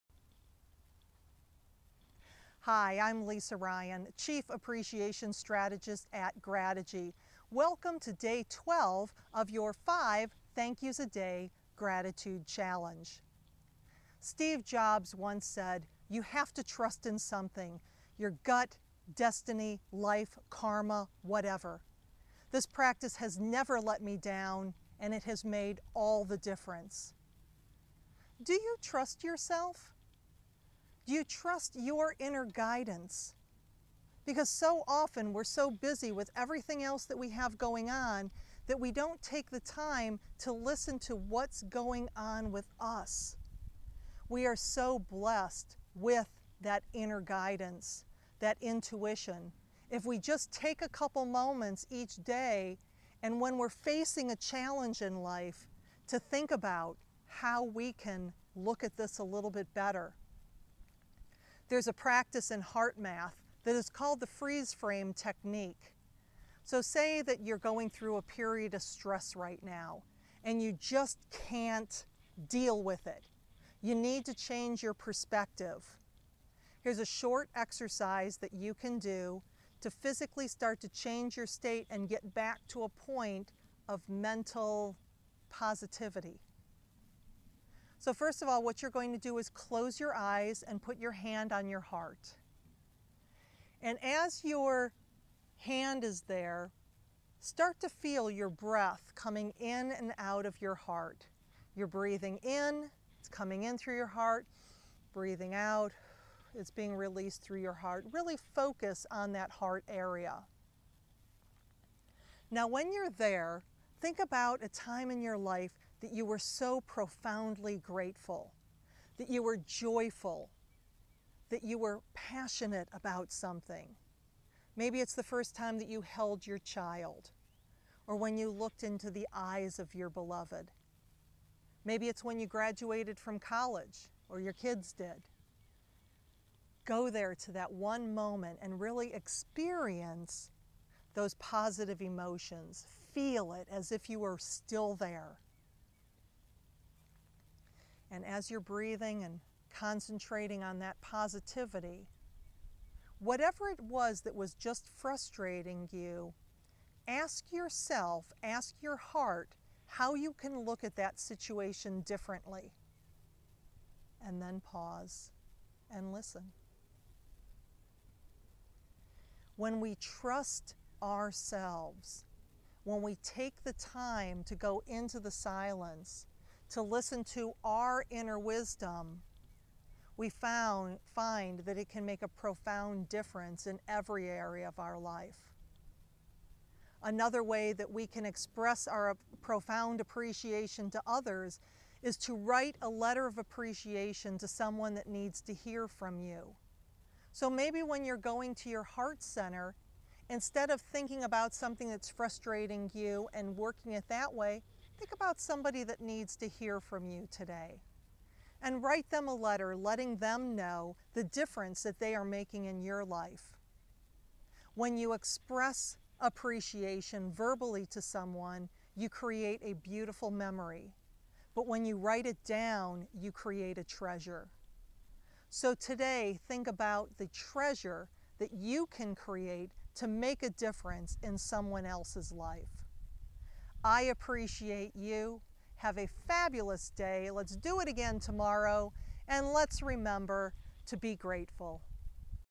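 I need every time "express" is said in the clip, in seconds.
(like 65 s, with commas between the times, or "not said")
188 s, 215 s.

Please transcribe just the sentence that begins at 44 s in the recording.
We are so blessed with that inner guidance, that intuition.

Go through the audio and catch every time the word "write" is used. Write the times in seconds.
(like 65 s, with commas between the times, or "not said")
192 s, 208 s, 221 s.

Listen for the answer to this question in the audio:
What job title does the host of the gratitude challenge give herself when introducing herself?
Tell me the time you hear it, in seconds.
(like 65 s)
4 s.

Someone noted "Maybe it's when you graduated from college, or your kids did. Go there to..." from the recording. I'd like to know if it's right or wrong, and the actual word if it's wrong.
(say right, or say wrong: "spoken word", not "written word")
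right.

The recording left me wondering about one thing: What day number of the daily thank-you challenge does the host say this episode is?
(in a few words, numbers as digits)
12.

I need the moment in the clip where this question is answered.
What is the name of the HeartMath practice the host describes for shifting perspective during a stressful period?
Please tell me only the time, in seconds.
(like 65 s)
64 s.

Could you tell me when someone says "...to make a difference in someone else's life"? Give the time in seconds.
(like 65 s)
229 s.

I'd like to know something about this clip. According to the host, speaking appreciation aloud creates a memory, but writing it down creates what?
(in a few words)
a treasure.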